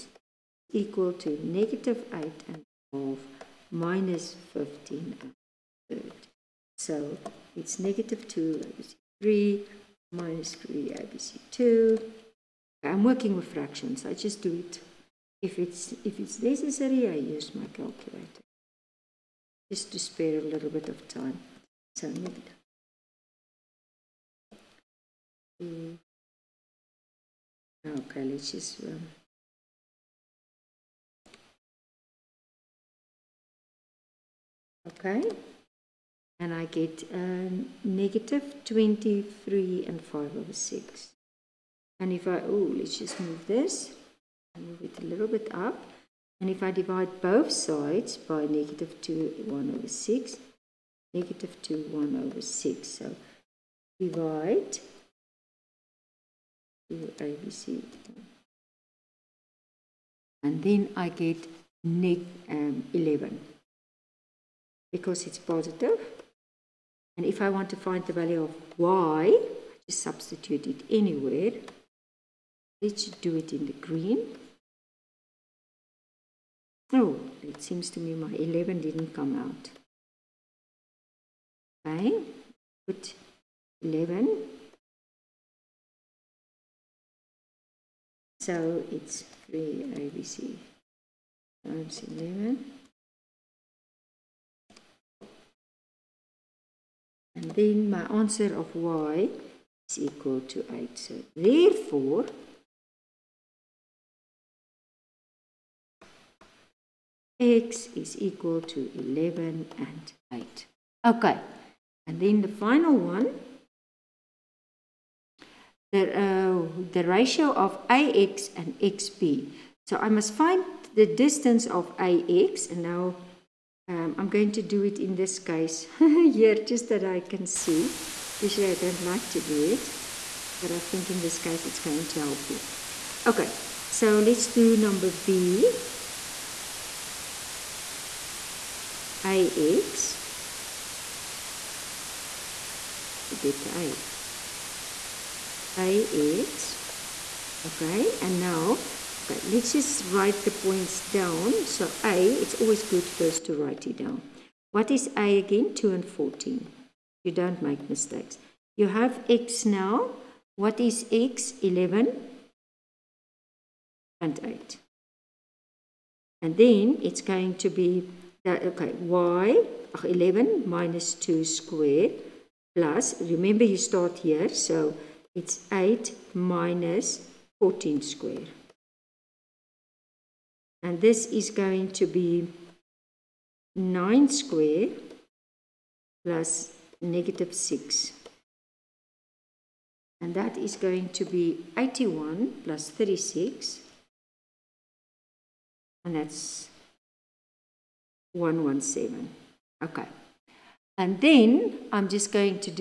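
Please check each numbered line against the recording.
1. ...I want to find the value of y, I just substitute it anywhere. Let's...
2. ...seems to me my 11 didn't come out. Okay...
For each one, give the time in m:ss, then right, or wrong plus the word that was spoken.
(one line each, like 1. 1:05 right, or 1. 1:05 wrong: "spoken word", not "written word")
1. 1:07 right
2. 1:17 right.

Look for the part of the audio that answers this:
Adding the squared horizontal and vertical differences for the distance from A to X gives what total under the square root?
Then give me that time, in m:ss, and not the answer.
3:18.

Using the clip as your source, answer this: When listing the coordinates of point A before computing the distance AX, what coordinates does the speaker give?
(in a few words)
(2, 14).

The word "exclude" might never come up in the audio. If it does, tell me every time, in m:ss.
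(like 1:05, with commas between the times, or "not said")
not said.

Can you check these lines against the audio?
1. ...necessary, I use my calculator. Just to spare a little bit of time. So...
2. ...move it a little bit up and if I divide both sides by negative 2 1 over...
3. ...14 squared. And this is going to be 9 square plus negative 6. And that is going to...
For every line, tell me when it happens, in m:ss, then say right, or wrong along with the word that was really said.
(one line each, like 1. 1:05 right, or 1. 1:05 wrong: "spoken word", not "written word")
1. 0:16 right
2. 0:44 right
3. 2:57 right.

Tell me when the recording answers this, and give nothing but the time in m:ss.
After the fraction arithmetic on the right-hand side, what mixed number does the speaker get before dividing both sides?
0:37.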